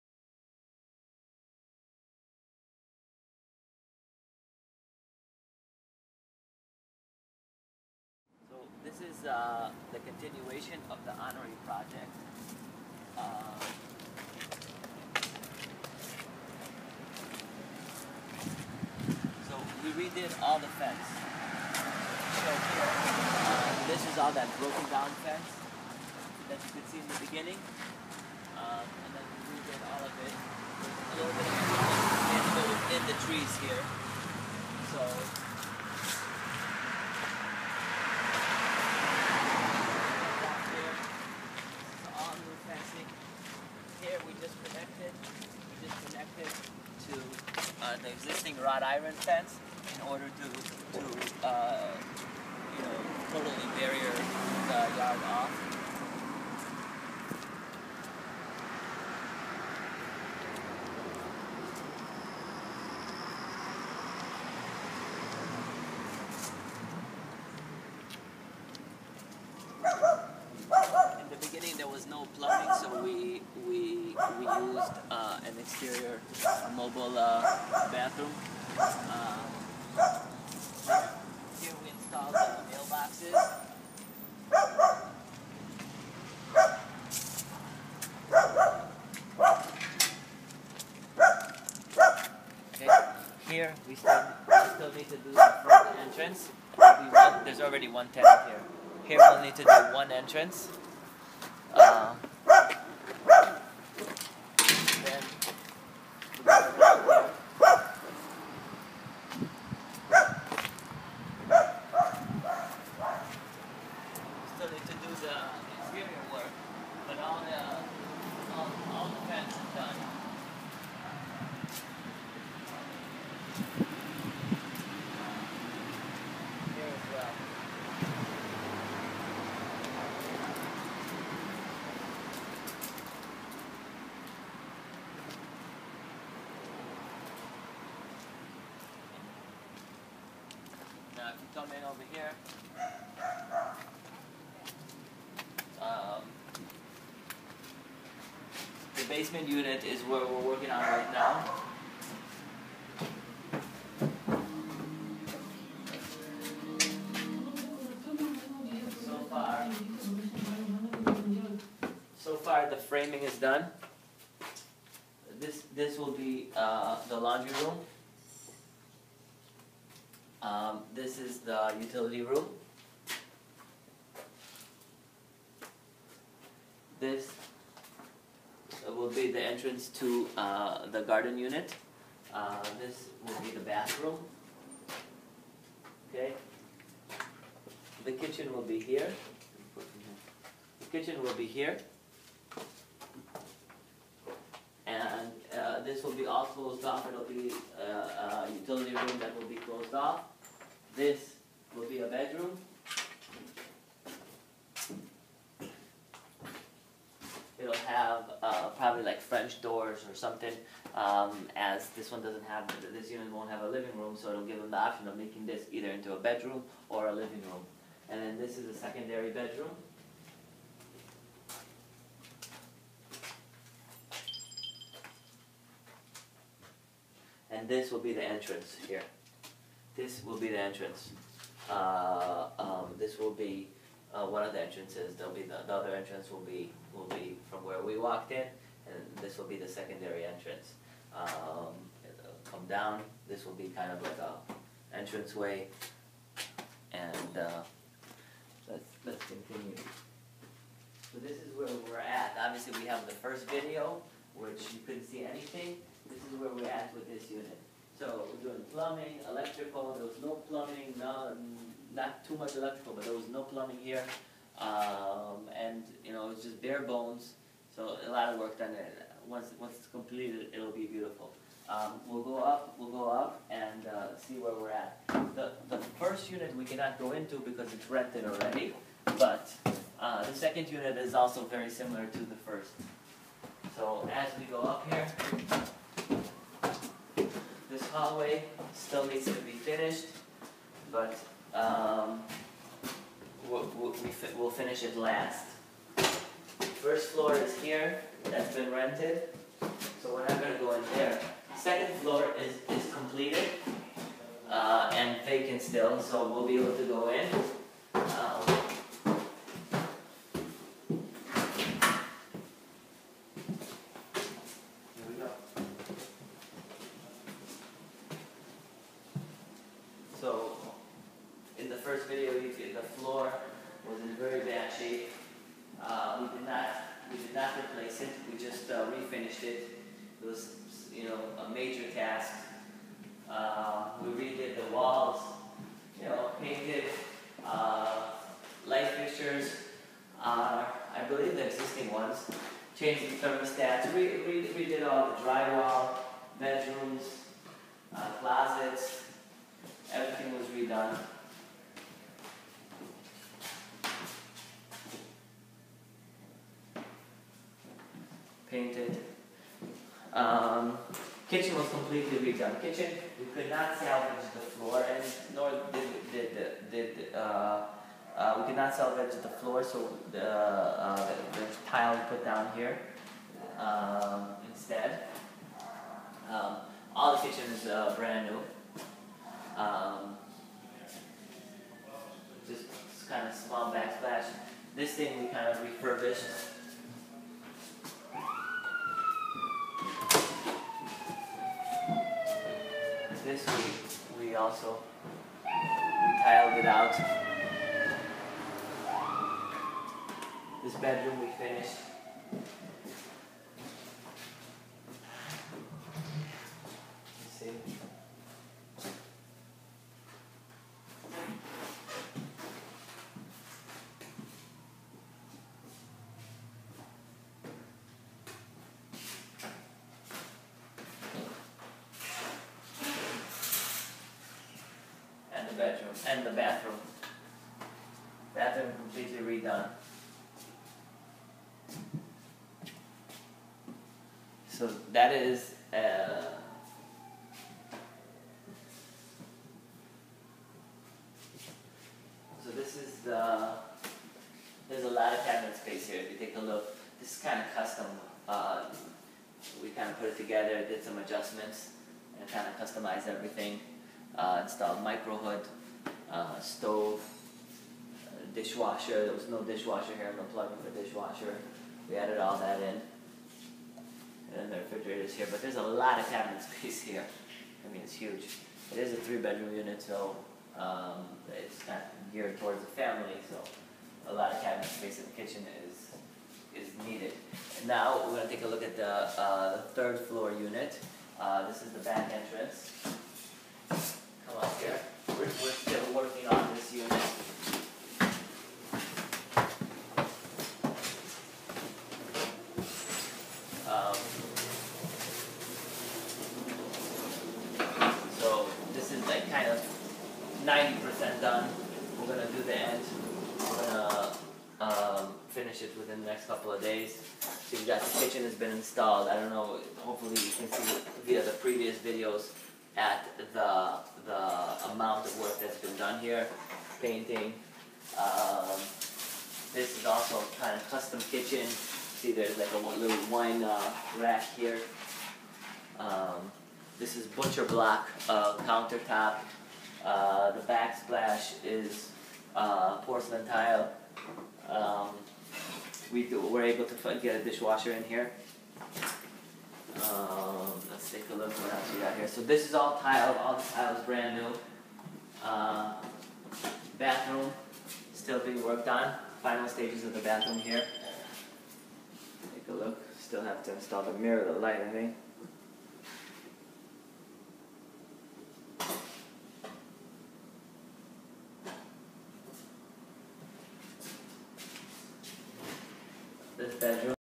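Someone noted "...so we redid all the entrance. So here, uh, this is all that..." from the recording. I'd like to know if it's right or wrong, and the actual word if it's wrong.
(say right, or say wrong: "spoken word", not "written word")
wrong: "fence", not "entrance".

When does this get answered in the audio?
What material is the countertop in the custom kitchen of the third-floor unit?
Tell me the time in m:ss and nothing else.
8:47.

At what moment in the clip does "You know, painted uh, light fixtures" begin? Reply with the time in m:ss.
5:35.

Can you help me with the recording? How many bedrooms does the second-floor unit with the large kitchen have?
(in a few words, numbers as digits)
3.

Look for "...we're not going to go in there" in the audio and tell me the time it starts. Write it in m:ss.
5:00.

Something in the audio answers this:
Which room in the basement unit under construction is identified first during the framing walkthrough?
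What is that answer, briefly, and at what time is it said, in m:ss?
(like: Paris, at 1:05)
laundry room, at 2:47.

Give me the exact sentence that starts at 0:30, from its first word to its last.
There's a little bit of in the trees here.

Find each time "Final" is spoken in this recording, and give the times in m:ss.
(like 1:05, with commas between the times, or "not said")
9:09.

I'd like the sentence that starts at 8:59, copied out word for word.
Um, let's take a look what else we got here.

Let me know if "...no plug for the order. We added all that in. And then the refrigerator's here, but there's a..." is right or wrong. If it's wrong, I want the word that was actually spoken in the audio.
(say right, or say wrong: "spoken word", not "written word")
wrong: "dishwasher", not "order".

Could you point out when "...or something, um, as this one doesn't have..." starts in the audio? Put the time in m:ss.
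3:30.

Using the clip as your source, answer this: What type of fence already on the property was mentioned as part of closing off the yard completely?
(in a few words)
wrought iron.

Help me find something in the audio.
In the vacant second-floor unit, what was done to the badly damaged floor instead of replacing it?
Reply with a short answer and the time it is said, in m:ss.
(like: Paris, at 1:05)
refinished it, at 5:28.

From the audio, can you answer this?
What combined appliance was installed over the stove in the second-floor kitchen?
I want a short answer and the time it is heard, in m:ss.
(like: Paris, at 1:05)
micro hood, at 7:34.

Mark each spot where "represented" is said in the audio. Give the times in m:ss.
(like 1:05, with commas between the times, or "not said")
not said.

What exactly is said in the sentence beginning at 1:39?
Here we'll need to do one entrance.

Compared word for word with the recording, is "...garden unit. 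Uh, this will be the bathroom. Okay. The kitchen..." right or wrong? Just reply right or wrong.
right.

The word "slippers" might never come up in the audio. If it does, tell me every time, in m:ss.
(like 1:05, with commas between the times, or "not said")
not said.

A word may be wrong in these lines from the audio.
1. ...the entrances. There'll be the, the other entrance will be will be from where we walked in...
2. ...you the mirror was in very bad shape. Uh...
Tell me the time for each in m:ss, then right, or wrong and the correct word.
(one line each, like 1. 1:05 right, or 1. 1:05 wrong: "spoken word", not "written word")
1. 3:54 right
2. 5:22 wrong: "floor", not "mirror".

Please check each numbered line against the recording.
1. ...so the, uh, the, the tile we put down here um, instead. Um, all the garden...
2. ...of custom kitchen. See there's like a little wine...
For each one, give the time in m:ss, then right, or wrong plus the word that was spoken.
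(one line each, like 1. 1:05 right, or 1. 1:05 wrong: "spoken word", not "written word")
1. 6:09 wrong: "kitchen", not "garden"
2. 8:40 right.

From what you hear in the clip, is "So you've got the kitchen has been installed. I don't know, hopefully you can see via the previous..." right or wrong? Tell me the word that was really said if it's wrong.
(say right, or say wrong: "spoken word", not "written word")
right.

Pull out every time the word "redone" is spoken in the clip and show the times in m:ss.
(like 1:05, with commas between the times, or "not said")
5:50, 6:02, 7:09.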